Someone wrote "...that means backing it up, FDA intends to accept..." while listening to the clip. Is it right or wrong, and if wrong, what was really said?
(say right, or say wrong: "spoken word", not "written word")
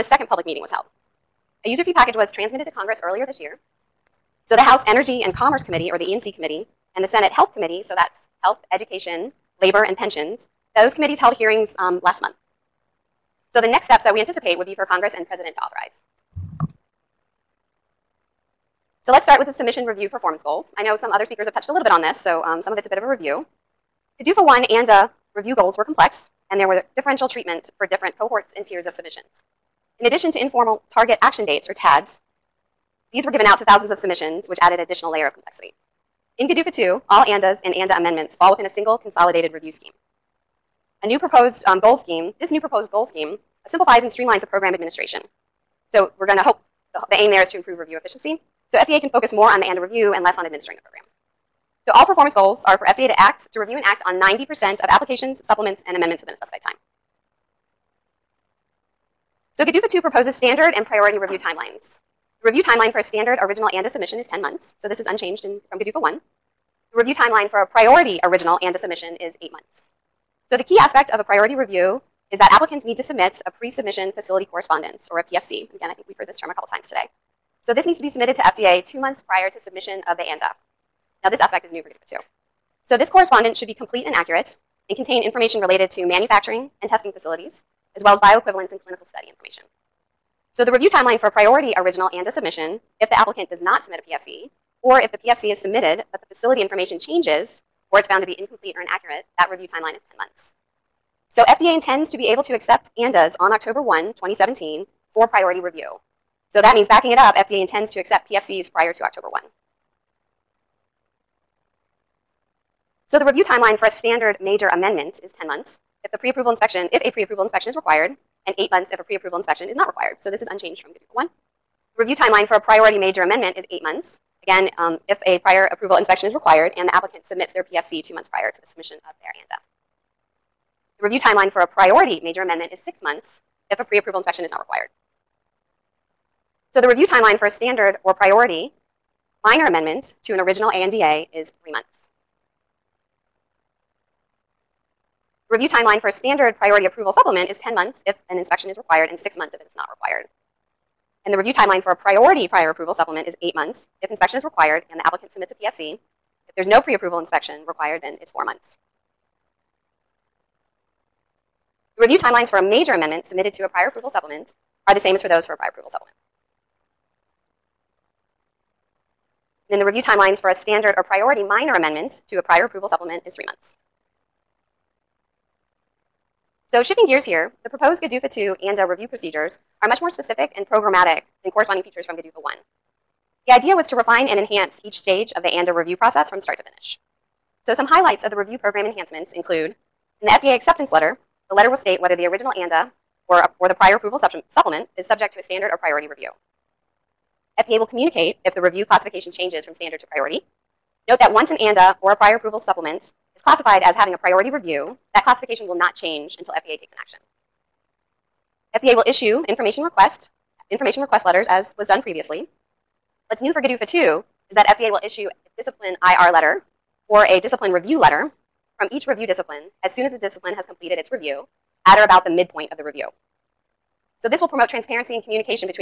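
right.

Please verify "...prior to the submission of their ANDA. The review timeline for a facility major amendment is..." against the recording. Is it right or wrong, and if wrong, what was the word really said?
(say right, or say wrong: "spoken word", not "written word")
wrong: "priority", not "facility".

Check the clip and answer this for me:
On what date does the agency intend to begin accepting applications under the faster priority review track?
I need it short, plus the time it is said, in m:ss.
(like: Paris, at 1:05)
October 1, 2017, at 1:43.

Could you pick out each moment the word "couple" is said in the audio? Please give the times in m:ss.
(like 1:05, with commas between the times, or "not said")
1:16.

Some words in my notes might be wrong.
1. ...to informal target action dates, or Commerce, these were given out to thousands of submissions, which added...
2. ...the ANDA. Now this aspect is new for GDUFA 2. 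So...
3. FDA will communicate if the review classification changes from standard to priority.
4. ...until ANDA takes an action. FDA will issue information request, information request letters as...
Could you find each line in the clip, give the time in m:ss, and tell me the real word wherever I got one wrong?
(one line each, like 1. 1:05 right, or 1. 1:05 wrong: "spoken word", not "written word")
1. 0:30 wrong: "TADs", not "Commerce"
2. 1:20 wrong: "GDPR", not "GDUFA"
3. 3:17 right
4. 3:26 wrong: "FDA", not "ANDA".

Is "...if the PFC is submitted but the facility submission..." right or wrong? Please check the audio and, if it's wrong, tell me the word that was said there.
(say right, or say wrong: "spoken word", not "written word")
wrong: "information", not "submission".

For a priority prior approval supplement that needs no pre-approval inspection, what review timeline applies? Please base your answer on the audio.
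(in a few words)
4 months.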